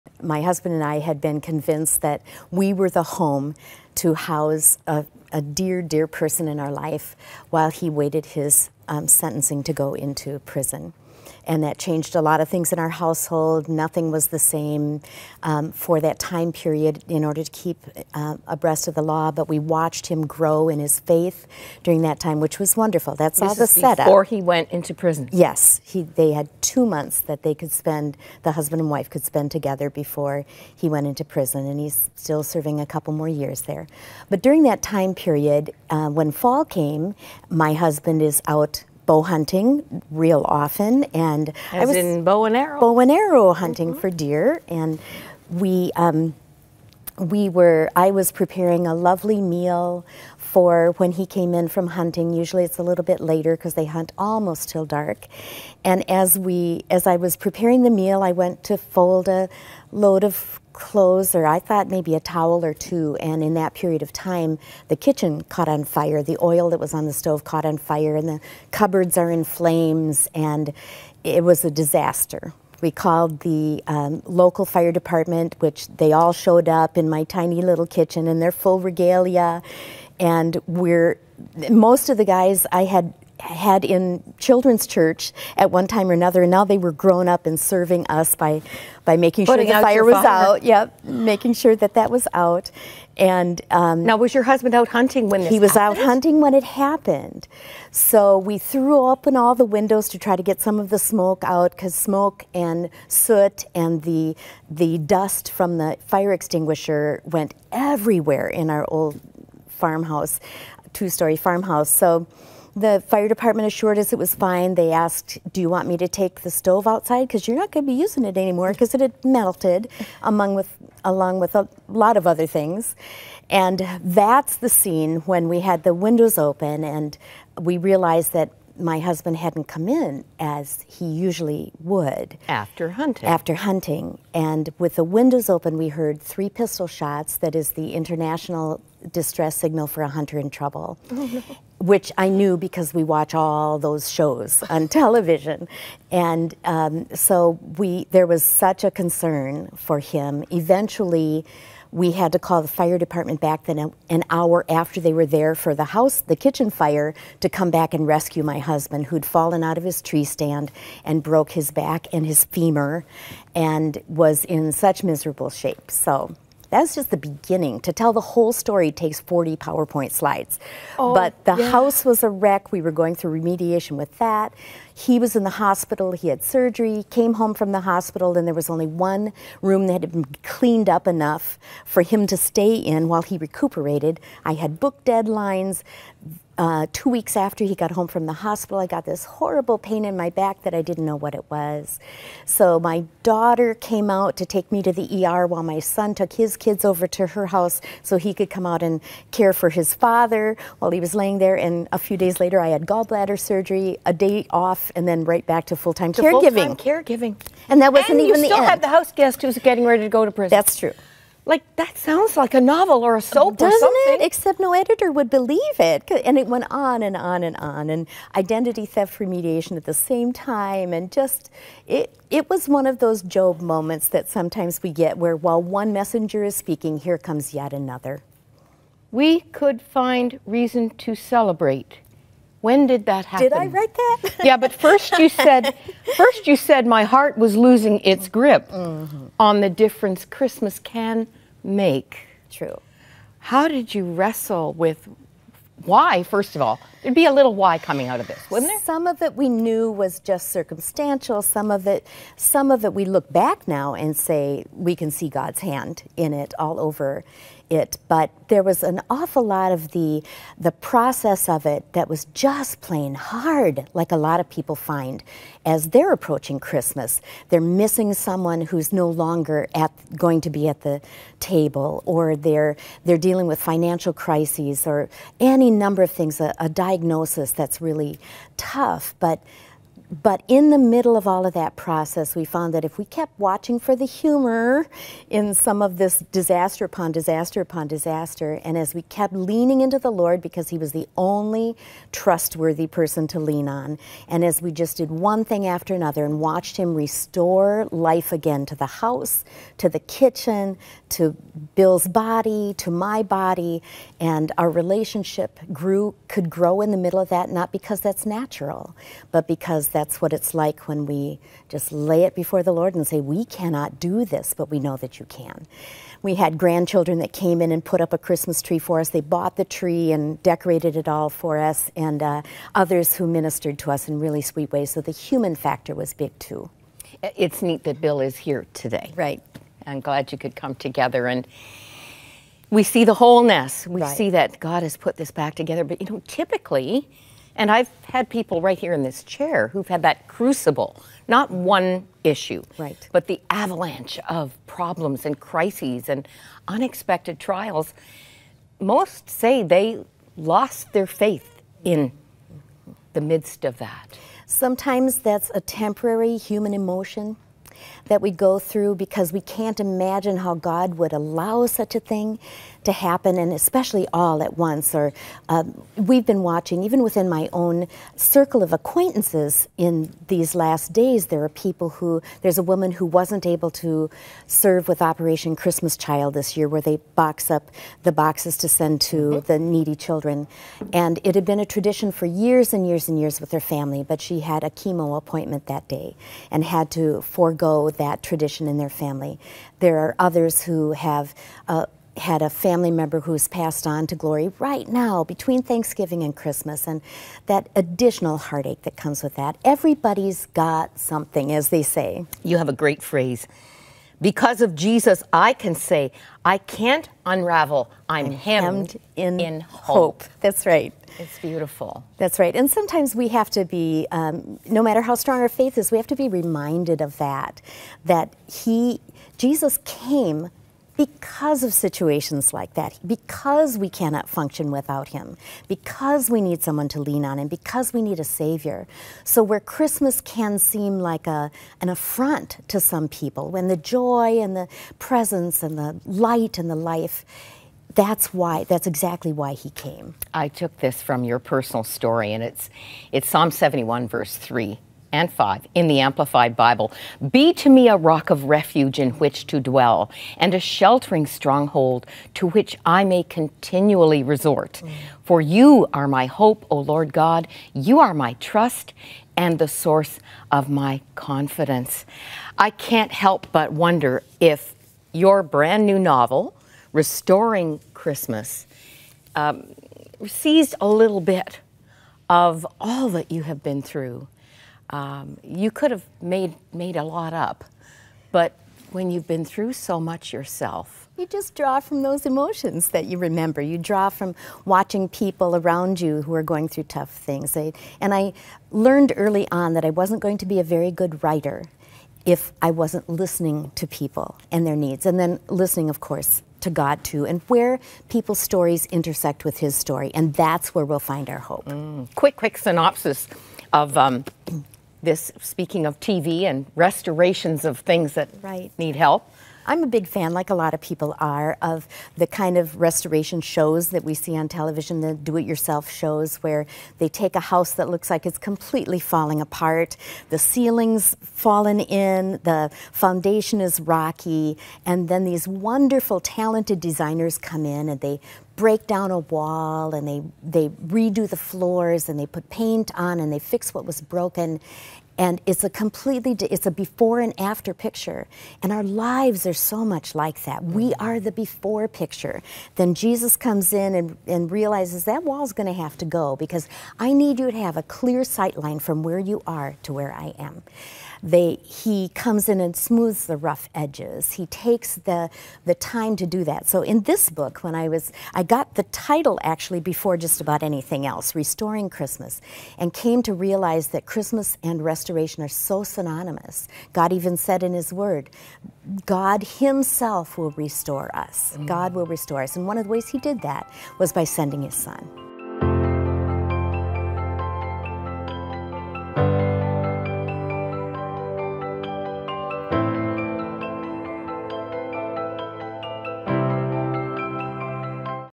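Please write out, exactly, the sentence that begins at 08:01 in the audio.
You just draw from those emotions that you remember.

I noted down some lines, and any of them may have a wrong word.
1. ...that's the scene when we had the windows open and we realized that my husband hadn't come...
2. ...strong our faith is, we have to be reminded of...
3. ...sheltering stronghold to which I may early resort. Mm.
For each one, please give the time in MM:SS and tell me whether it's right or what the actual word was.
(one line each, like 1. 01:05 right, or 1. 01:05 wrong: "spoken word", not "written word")
1. 02:04 right
2. 06:55 right
3. 07:30 wrong: "continually", not "early".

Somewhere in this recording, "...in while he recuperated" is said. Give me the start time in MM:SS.
03:02.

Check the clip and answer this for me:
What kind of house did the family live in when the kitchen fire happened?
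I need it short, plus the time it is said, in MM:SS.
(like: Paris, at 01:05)
two story farmhouse, at 01:50.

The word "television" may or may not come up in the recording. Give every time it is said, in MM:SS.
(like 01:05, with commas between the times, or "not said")
02:24, 08:34.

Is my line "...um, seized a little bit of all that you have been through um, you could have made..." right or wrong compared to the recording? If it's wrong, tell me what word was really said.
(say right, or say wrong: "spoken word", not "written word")
right.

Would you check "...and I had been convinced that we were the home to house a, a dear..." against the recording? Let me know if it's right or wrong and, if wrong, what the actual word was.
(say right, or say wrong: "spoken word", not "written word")
right.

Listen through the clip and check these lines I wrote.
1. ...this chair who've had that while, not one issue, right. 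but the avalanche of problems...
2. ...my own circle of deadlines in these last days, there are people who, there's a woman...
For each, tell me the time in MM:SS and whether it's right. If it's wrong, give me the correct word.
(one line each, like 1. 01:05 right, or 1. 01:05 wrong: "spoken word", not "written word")
1. 05:39 wrong: "crucible", not "while"
2. 06:07 wrong: "acquaintances", not "deadlines".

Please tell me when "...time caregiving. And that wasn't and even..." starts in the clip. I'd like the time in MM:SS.
03:26.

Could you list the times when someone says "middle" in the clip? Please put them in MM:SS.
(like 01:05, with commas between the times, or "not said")
04:40, 05:06.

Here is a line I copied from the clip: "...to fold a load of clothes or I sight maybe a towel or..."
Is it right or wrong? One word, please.
wrong.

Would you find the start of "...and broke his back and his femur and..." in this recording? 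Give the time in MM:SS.
02:41.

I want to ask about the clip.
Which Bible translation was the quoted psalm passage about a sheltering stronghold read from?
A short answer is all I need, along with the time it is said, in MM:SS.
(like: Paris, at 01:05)
Amplified Bible, at 07:25.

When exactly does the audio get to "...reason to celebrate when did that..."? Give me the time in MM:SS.
03:50.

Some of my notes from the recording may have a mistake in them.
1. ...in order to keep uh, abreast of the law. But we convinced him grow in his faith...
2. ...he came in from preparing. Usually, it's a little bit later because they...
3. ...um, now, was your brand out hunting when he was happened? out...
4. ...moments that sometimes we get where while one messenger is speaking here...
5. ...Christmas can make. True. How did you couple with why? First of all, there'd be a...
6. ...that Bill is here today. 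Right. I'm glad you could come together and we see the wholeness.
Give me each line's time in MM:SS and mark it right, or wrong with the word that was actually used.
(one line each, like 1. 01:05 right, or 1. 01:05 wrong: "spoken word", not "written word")
1. 00:17 wrong: "watched", not "convinced"
2. 00:51 wrong: "hunting", not "preparing"
3. 01:33 wrong: "husband", not "brand"
4. 03:43 right
5. 04:00 wrong: "wrestle", not "couple"
6. 05:27 right.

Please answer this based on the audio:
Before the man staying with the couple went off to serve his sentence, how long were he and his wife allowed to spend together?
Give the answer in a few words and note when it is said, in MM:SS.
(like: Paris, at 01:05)
2 months, at 00:26.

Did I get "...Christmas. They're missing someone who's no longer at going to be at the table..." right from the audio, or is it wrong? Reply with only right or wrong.
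right.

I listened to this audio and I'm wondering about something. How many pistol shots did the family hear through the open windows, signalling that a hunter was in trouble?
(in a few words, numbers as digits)
3.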